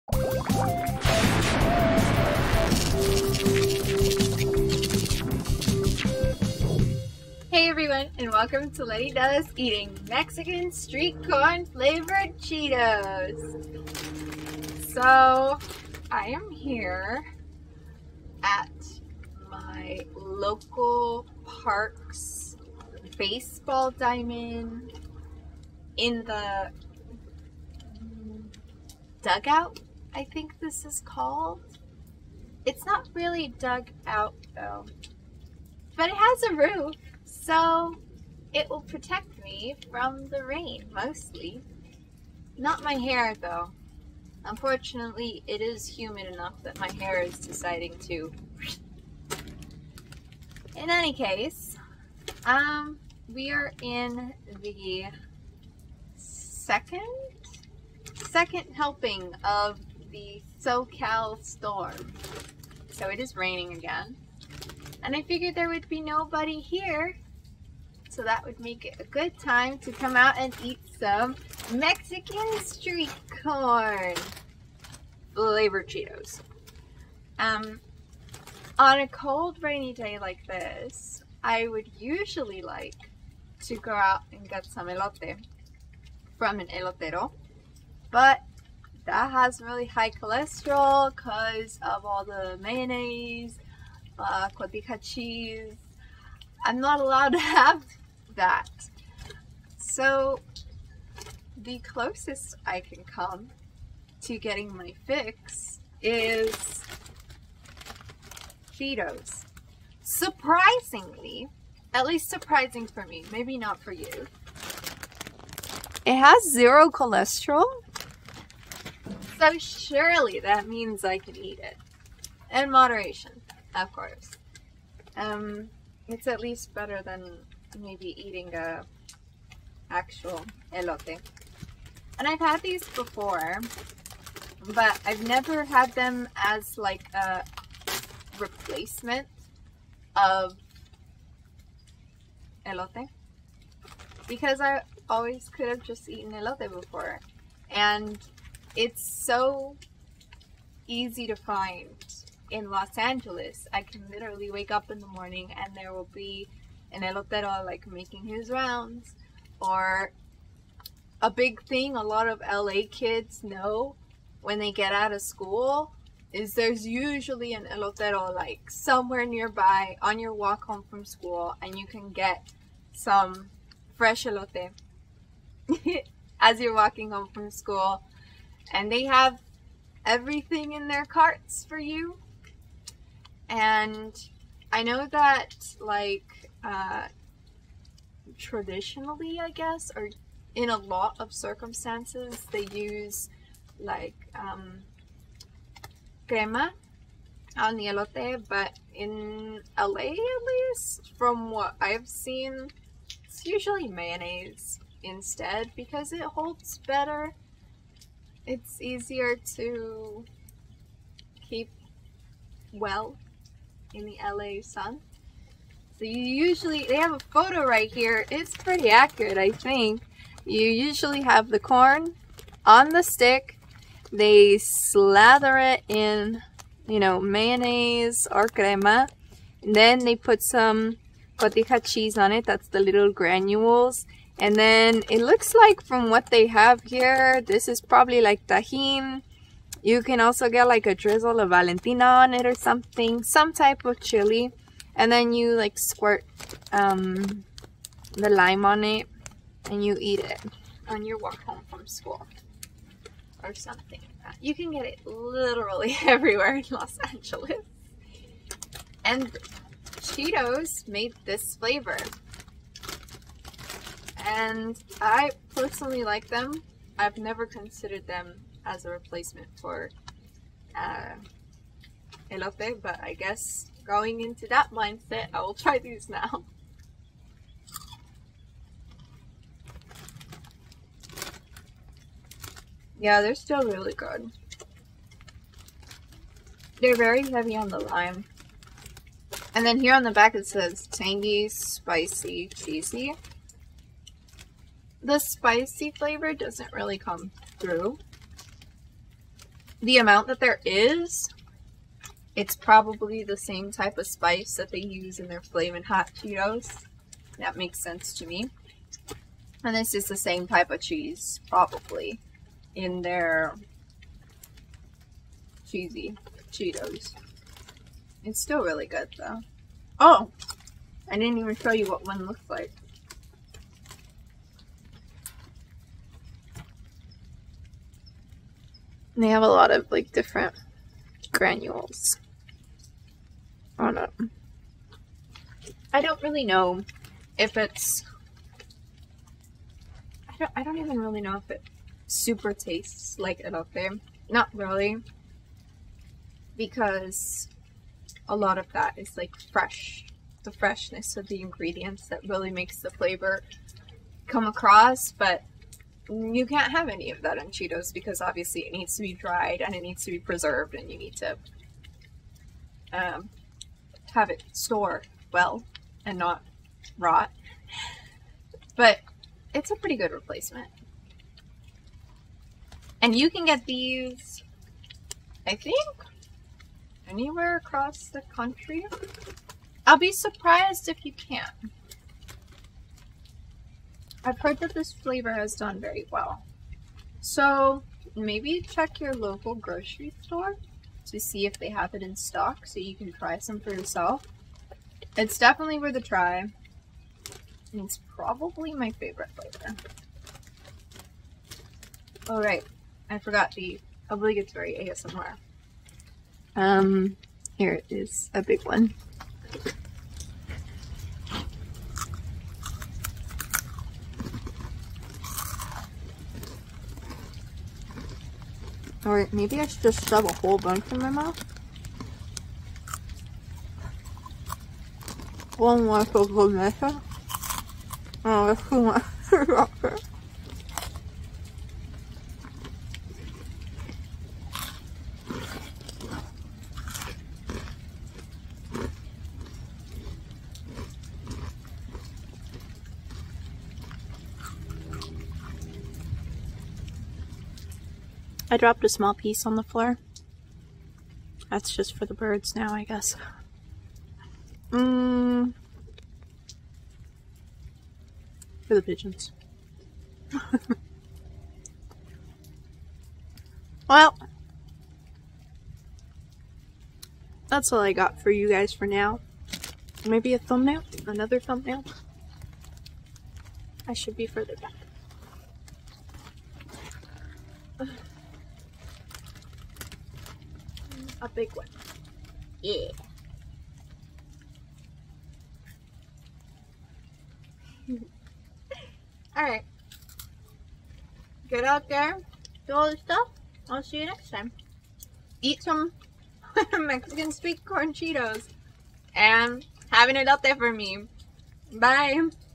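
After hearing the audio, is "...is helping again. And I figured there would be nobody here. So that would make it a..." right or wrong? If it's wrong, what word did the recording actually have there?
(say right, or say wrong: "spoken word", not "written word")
wrong: "raining", not "helping".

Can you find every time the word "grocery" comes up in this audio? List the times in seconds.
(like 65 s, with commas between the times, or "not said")
389 s.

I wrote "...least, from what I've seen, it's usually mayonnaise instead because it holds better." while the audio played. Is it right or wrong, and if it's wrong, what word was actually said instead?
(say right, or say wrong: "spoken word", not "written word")
right.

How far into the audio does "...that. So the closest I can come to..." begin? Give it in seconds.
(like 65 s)
98 s.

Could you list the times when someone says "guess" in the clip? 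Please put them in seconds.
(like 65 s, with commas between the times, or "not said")
189 s, 273 s, 452 s.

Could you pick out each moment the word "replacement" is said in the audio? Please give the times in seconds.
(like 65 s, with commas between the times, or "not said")
138 s, 268 s, 370 s.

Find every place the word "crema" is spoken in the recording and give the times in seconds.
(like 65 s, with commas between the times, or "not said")
196 s, 228 s.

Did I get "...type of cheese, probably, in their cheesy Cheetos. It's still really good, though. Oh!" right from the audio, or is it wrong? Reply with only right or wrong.
right.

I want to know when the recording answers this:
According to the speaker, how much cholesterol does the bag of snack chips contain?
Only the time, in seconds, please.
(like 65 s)
116 s.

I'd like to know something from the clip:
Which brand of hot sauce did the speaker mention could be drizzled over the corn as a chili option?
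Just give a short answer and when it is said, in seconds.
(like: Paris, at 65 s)
Valentina, at 241 s.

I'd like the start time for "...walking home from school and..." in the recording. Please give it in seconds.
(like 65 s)
176 s.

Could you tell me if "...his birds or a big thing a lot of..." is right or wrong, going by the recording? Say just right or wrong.
wrong.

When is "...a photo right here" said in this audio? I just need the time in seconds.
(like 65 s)
217 s.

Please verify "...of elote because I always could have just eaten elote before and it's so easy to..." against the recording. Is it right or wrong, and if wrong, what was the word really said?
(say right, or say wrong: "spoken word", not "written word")
right.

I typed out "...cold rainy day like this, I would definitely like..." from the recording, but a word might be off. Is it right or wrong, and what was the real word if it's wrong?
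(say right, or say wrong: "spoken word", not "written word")
wrong: "usually", not "definitely".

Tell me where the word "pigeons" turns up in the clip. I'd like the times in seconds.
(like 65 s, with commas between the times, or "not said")
458 s.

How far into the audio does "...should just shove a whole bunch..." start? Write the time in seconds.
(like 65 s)
419 s.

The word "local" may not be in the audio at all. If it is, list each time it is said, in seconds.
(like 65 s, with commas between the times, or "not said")
20 s, 389 s.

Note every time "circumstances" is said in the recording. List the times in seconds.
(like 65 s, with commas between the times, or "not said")
191 s.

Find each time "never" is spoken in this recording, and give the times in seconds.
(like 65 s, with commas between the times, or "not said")
135 s, 267 s.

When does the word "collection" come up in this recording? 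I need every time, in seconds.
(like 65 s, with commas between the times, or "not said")
not said.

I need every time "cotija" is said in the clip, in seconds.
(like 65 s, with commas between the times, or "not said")
94 s, 231 s.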